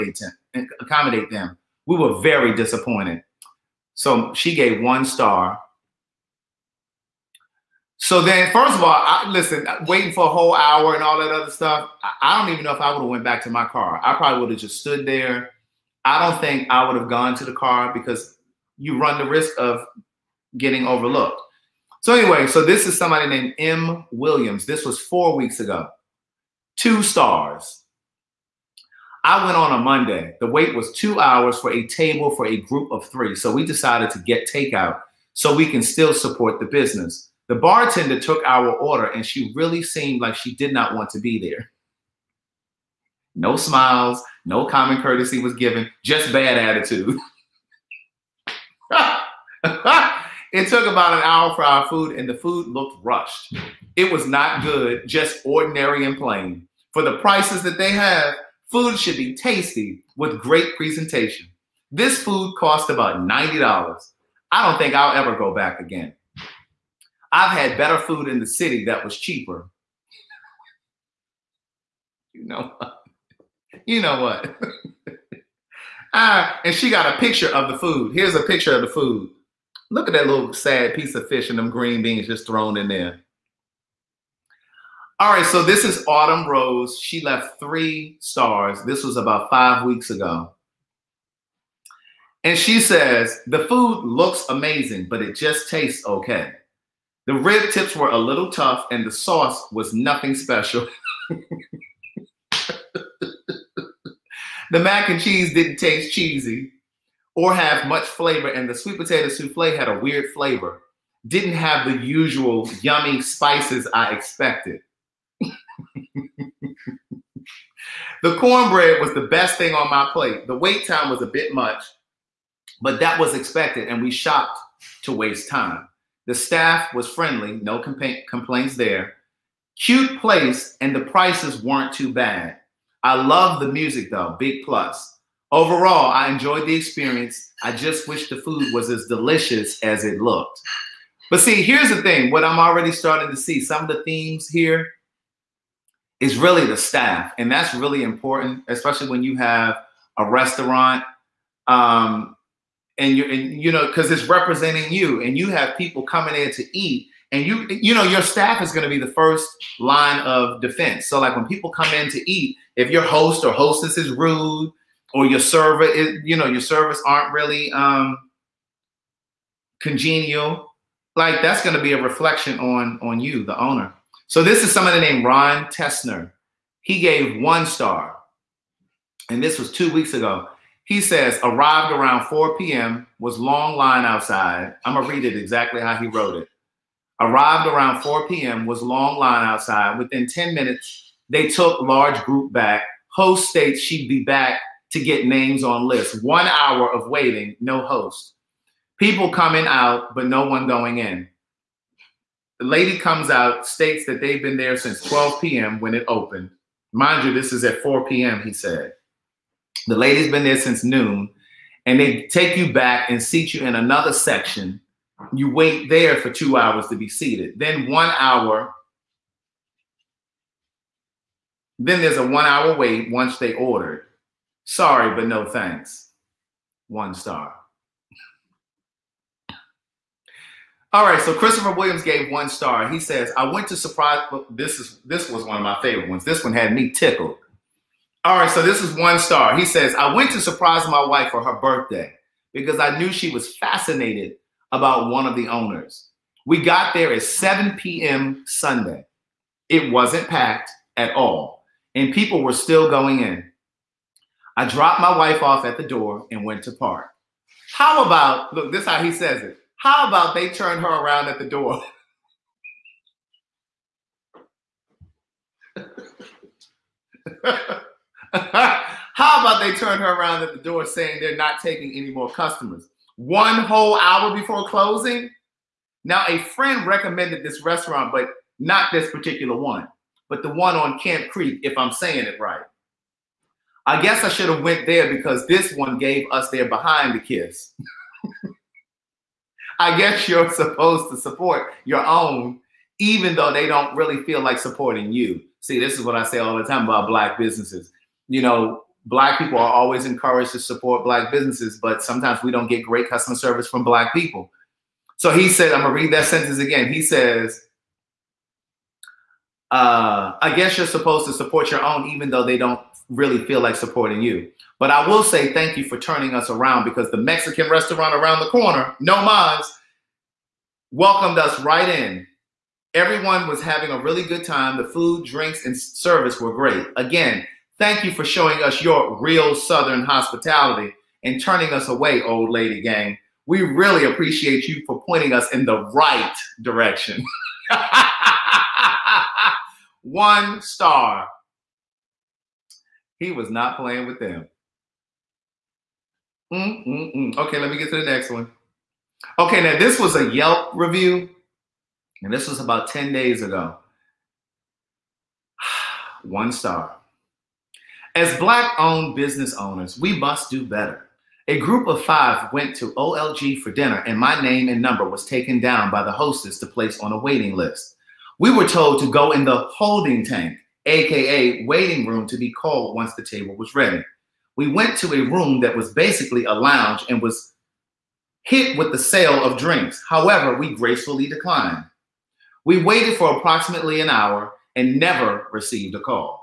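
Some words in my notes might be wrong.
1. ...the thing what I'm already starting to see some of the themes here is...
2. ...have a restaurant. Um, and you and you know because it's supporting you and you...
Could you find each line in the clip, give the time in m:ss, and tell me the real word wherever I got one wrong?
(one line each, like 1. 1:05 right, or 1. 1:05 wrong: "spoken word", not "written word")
1. 2:21 right
2. 2:29 wrong: "representing", not "supporting".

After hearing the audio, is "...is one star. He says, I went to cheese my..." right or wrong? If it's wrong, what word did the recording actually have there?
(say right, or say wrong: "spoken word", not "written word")
wrong: "surprise", not "cheese".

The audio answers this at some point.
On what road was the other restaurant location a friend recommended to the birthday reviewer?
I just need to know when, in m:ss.
4:40.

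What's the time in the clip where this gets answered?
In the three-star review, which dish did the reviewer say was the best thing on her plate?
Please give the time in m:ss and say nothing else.
1:58.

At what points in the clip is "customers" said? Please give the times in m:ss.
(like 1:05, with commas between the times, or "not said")
4:32, 5:03.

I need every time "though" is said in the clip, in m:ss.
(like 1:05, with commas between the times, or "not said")
2:14, 4:53, 5:12.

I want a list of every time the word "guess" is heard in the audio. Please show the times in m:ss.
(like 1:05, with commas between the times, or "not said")
4:44, 4:49, 5:10.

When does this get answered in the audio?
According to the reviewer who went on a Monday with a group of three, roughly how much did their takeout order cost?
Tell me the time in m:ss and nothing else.
1:03.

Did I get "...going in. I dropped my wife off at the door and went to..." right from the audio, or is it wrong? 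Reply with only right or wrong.
right.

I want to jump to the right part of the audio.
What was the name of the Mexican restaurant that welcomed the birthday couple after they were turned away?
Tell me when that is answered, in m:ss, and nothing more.
5:19.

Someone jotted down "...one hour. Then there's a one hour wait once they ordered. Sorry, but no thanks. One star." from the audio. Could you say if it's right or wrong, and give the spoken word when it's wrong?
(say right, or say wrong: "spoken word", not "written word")
right.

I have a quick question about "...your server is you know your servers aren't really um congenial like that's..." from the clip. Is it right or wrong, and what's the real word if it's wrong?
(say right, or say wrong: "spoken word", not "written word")
right.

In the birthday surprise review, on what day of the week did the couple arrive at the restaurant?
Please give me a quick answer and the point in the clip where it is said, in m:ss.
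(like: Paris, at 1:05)
Sunday, at 4:08.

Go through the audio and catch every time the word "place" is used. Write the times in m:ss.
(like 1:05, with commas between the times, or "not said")
2:10, 6:06.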